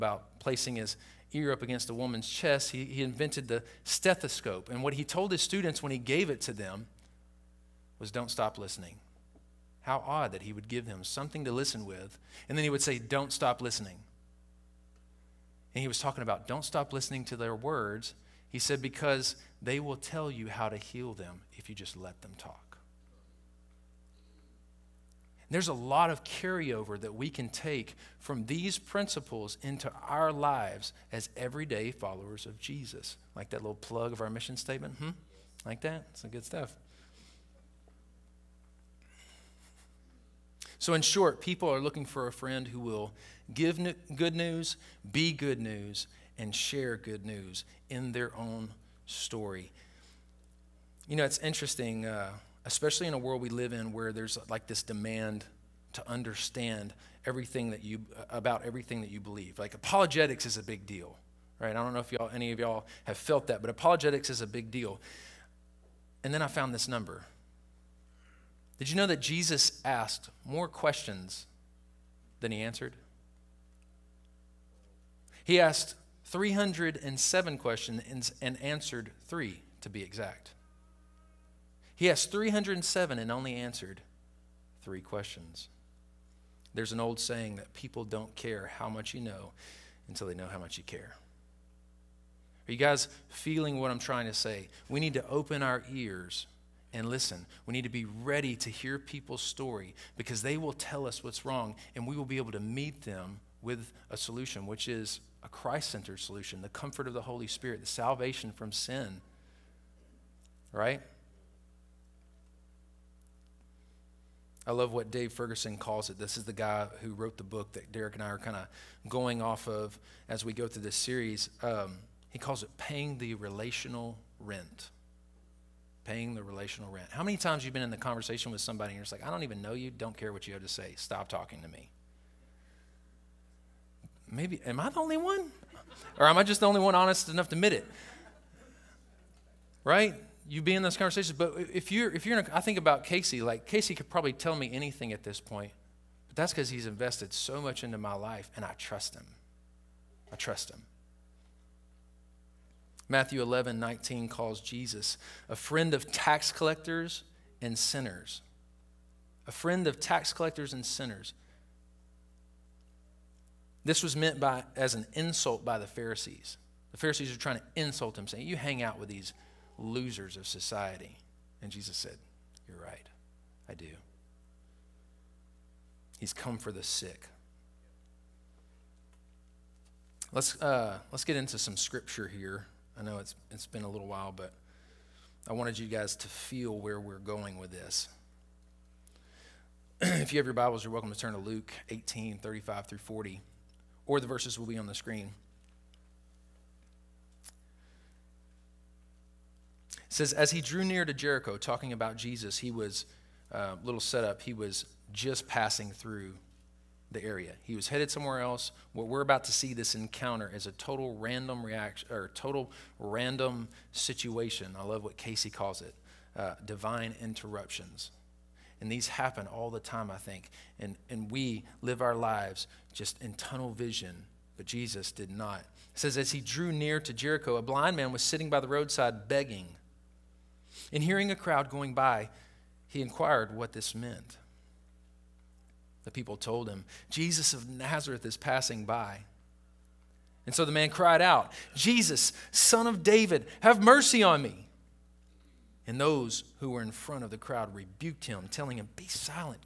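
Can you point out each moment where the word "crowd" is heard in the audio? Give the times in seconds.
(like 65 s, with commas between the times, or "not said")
231 s, 247 s.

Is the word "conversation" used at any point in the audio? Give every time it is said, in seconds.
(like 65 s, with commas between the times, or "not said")
127 s, 140 s.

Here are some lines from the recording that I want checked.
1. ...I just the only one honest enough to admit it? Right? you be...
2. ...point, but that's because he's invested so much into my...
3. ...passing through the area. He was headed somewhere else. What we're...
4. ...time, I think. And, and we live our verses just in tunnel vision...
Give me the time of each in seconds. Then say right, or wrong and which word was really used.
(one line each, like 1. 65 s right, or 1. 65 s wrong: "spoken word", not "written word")
1. 136 s right
2. 145 s right
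3. 205 s right
4. 219 s wrong: "lives", not "verses".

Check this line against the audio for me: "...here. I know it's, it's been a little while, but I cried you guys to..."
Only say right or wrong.
wrong.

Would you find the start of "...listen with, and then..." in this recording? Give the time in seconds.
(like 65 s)
11 s.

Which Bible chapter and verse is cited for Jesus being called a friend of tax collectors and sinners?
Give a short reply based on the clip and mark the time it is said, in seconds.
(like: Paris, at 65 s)
Matthew 11:19, at 153 s.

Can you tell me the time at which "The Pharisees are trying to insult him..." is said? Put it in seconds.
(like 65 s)
166 s.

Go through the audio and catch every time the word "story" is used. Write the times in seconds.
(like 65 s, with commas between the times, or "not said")
49 s, 99 s.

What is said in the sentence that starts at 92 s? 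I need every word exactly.
Are you guys feeling what I'm trying to say?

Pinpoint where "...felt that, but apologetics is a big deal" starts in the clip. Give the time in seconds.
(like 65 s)
63 s.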